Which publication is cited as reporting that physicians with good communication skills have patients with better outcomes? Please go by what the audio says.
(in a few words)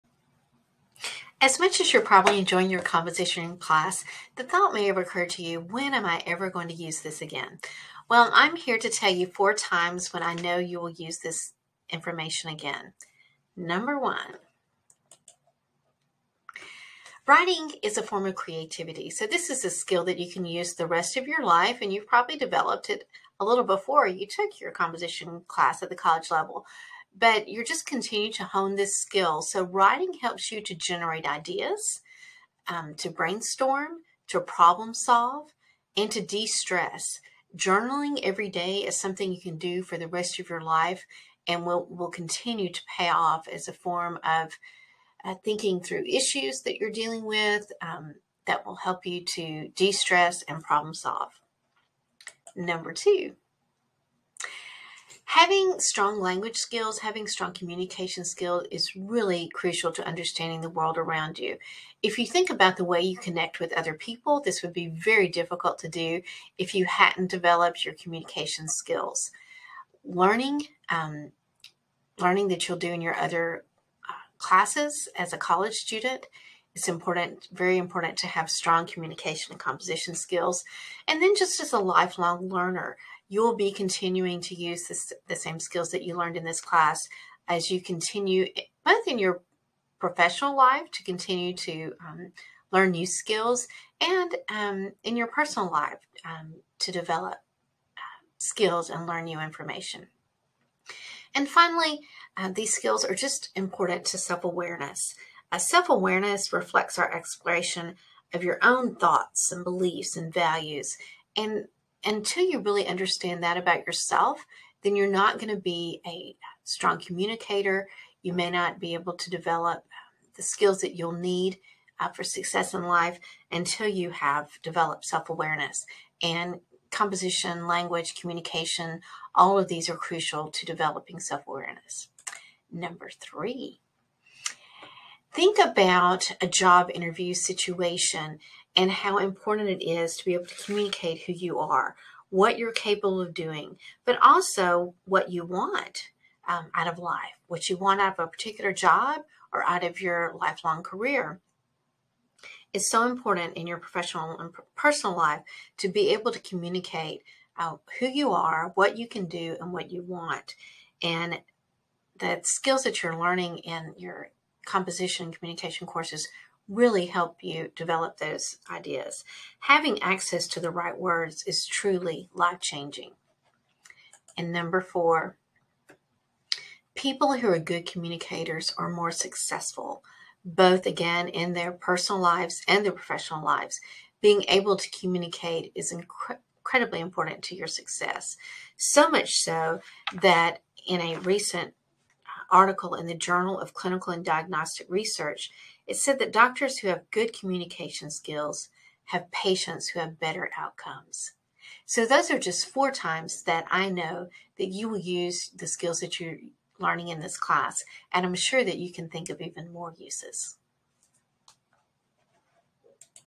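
Journal of Clinical and Diagnostic Research.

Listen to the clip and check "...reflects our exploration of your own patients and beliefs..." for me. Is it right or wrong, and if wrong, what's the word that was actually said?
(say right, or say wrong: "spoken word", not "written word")
wrong: "thoughts", not "patients".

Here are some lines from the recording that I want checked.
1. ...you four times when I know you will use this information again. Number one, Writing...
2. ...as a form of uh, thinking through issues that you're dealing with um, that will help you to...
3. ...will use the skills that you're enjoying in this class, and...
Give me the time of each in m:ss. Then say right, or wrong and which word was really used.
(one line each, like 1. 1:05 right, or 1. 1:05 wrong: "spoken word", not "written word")
1. 0:09 right
2. 0:43 right
3. 3:24 wrong: "learning", not "enjoying".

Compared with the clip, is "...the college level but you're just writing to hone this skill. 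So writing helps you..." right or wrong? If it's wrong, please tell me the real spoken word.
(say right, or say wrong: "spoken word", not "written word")
wrong: "continuing", not "writing".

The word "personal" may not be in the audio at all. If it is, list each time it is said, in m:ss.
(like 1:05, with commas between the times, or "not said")
1:35, 2:34, 3:01.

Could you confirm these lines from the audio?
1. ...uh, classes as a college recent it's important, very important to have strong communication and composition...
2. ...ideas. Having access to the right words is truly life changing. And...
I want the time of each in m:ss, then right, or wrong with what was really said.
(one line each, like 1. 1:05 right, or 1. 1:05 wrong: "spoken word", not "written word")
1. 1:14 wrong: "student", not "recent"
2. 2:48 right.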